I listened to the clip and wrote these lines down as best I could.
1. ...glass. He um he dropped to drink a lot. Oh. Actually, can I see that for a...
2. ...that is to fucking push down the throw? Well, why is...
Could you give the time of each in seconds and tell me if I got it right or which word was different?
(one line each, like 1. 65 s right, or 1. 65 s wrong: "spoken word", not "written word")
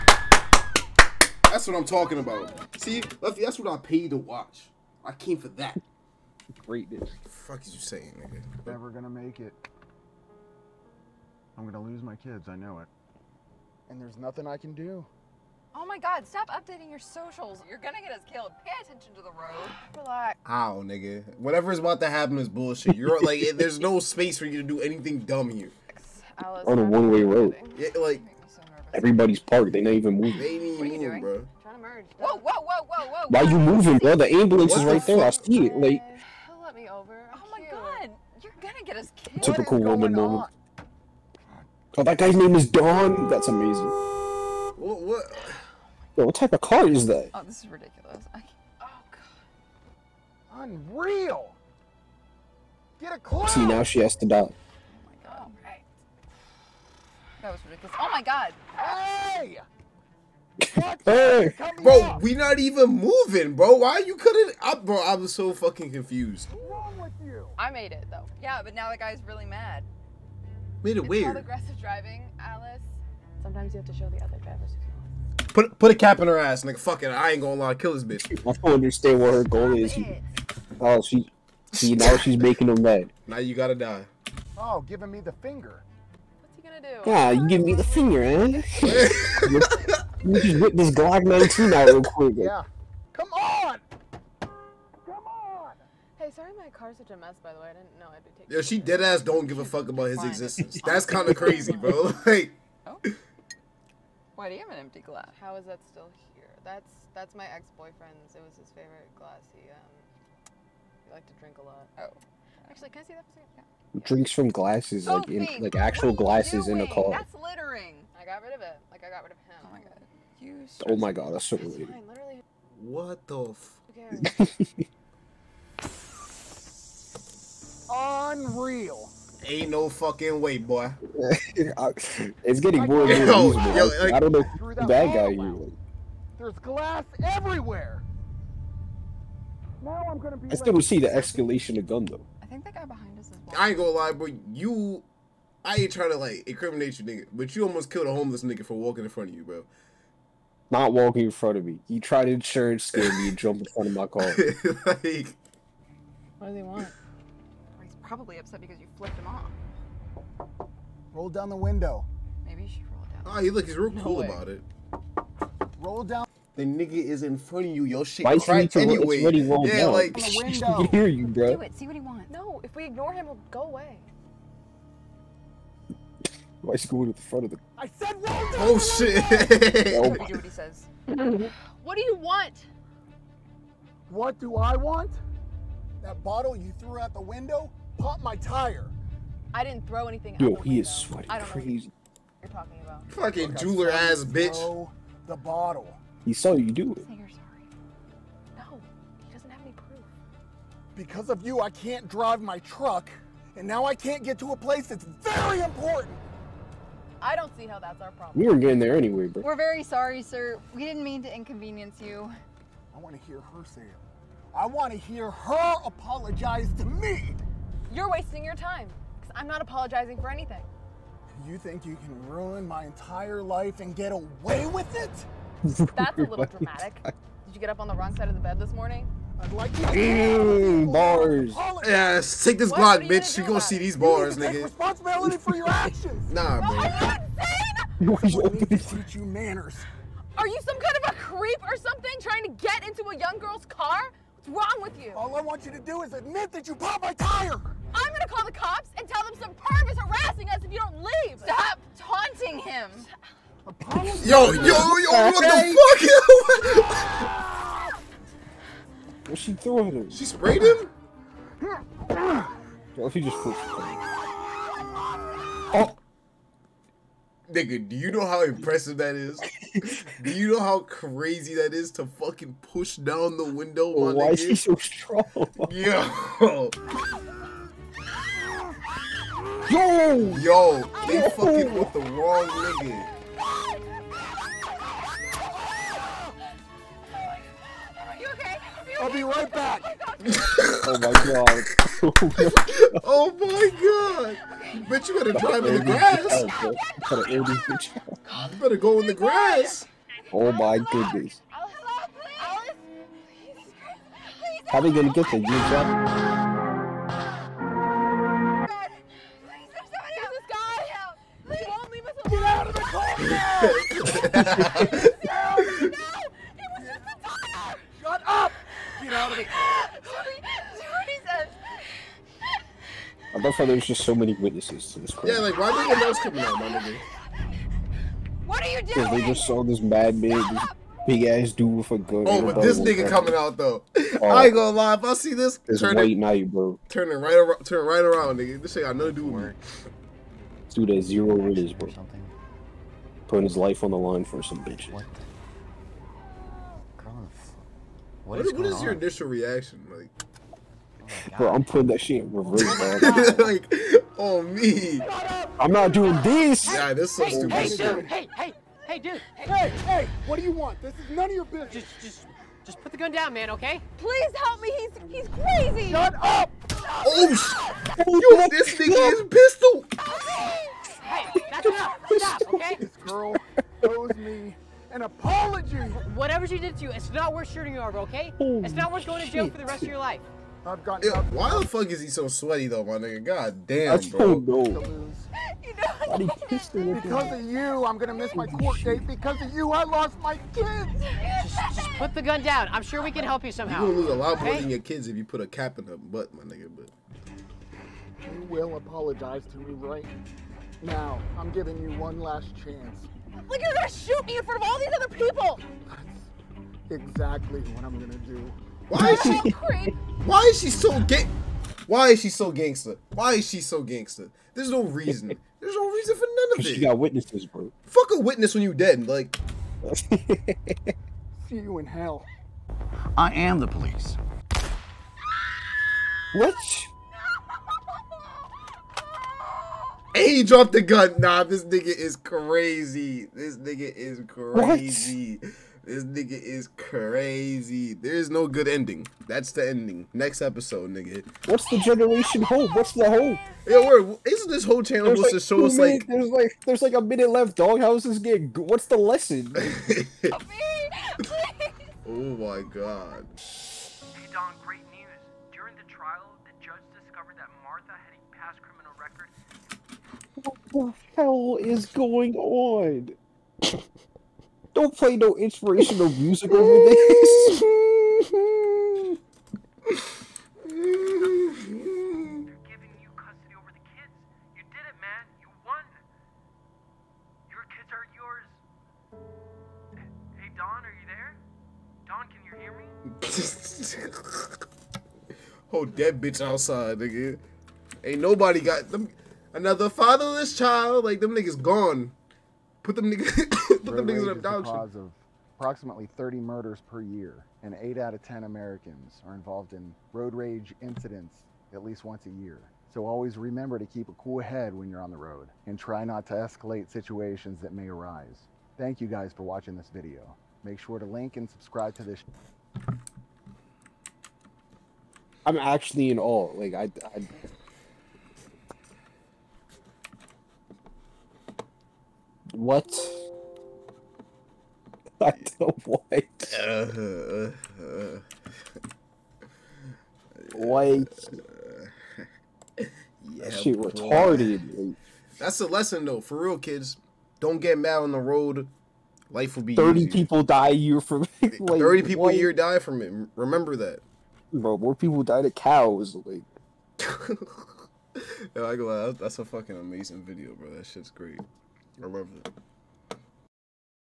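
1. 109 s wrong: "liked", not "dropped"
2. 271 s wrong: "window", not "throw".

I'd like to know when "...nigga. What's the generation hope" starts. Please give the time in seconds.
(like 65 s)
440 s.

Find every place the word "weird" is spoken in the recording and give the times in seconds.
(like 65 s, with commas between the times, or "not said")
71 s, 121 s.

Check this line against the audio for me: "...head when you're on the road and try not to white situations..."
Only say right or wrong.
wrong.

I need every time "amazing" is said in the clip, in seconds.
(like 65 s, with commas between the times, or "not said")
43 s, 549 s.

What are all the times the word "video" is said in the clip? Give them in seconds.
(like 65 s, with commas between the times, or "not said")
509 s, 550 s.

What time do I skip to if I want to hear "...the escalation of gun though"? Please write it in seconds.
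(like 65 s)
140 s.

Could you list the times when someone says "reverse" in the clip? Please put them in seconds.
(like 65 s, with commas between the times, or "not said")
352 s.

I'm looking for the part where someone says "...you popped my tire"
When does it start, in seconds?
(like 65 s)
246 s.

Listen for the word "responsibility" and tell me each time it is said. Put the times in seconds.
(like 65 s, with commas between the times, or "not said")
234 s.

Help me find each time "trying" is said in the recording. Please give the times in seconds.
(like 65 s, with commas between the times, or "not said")
145 s, 242 s.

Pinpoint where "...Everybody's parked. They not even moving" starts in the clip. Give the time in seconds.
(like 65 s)
28 s.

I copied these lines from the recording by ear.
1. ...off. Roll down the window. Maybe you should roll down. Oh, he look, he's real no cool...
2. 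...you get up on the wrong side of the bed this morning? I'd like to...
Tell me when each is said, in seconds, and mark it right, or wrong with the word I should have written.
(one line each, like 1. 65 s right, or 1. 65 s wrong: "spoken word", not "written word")
1. 159 s right
2. 227 s right.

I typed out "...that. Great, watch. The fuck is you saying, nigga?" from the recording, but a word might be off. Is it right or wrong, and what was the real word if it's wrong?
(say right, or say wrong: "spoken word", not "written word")
wrong: "bitch", not "watch".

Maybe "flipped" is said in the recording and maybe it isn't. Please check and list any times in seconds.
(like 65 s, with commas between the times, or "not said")
158 s, 263 s.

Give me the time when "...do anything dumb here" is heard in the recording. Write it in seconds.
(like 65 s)
24 s.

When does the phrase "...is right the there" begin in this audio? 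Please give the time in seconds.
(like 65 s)
34 s.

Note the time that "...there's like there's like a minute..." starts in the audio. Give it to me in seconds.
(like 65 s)
446 s.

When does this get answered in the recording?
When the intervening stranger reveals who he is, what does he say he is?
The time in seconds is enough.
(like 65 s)
423 s.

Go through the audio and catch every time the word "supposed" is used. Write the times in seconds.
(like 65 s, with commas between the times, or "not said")
445 s.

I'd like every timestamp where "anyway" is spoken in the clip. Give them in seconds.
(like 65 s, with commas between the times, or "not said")
168 s, 208 s.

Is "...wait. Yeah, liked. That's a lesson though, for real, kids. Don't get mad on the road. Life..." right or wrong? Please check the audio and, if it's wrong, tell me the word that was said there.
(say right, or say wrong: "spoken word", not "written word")
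wrong: "retarded", not "liked".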